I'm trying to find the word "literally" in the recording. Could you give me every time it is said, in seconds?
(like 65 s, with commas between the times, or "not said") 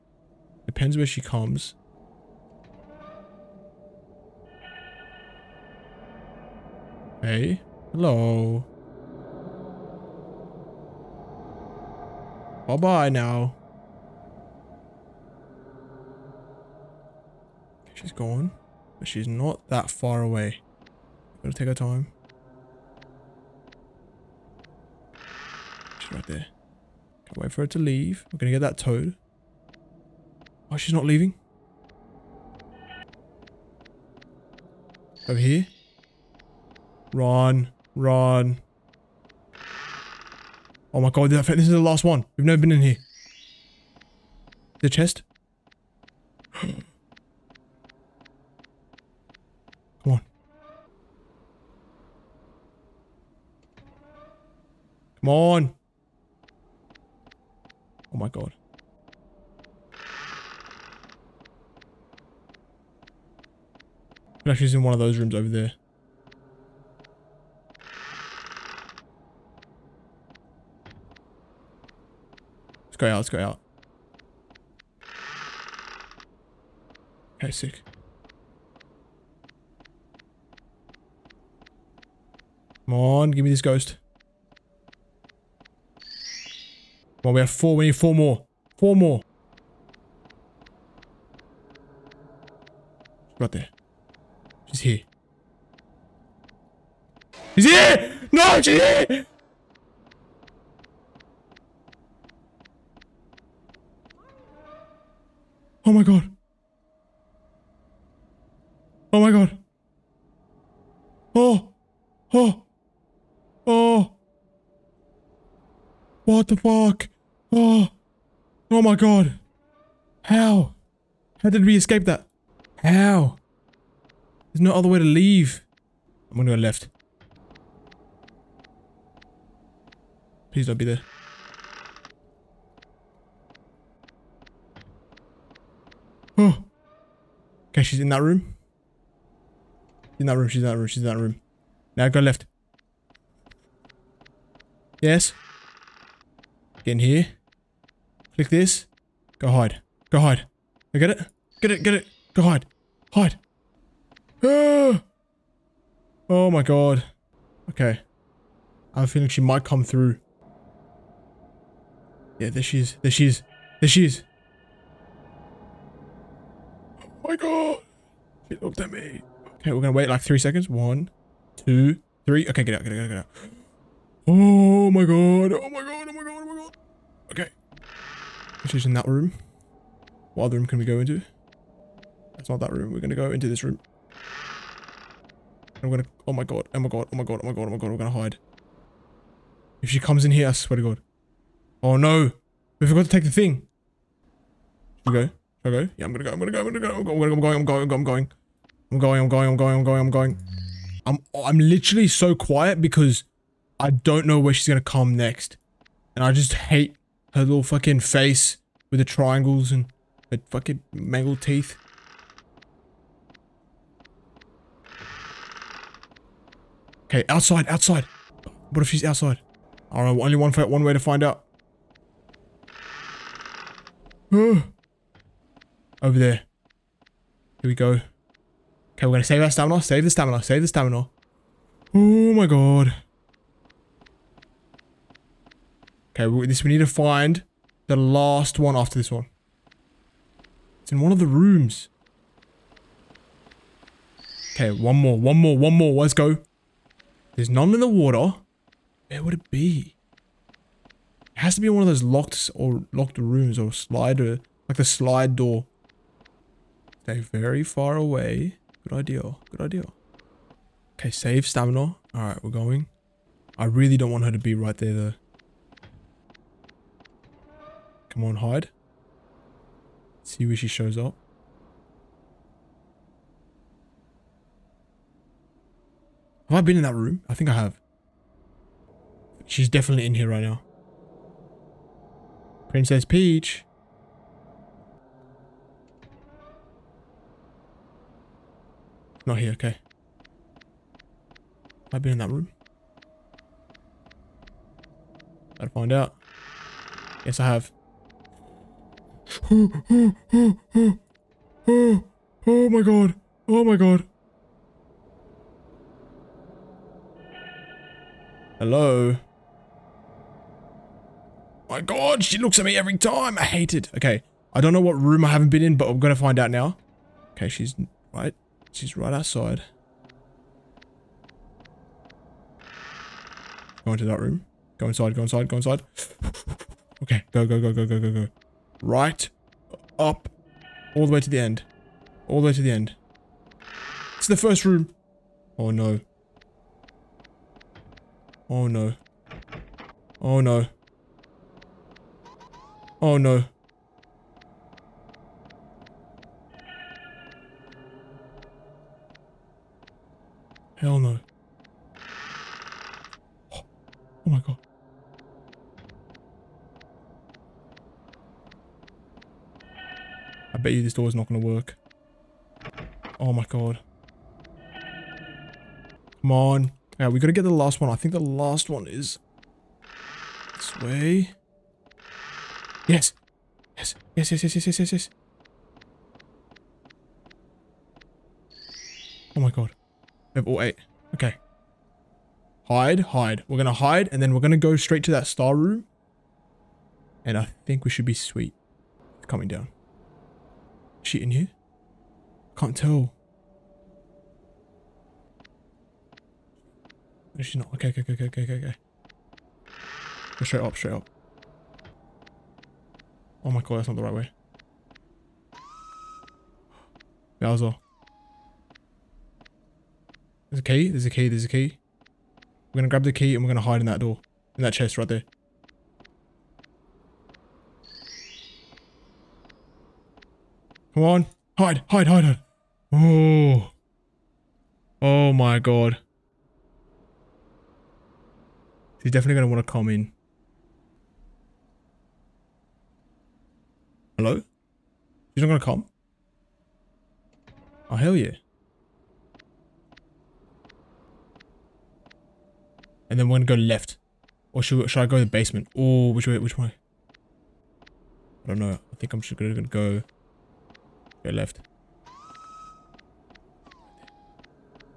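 201 s.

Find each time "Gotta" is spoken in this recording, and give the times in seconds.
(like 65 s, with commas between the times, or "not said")
21 s, 295 s.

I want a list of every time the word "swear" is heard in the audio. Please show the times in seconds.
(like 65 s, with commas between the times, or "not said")
190 s.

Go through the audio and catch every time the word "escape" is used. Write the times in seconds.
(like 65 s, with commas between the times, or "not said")
121 s.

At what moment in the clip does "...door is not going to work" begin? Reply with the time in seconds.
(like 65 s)
360 s.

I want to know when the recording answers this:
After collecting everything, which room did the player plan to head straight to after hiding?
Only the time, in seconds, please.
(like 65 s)
385 s.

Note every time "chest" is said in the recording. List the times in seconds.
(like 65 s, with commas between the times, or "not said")
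44 s, 414 s.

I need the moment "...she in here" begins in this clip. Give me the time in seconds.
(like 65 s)
391 s.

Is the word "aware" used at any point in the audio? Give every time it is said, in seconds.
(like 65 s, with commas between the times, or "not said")
not said.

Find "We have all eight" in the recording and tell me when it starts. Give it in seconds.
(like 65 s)
380 s.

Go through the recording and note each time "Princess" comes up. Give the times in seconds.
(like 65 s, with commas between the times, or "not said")
282 s.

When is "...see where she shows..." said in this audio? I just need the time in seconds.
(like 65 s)
270 s.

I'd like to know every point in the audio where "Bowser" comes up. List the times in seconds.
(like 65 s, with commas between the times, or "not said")
407 s.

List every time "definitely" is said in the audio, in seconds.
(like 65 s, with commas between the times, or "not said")
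279 s, 429 s.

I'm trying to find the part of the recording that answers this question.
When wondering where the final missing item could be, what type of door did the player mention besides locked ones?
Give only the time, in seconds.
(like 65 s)
254 s.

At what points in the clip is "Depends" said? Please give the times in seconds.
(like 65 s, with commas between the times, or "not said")
0 s.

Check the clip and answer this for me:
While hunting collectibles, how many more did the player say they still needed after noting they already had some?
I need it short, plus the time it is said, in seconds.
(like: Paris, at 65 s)
4, at 87 s.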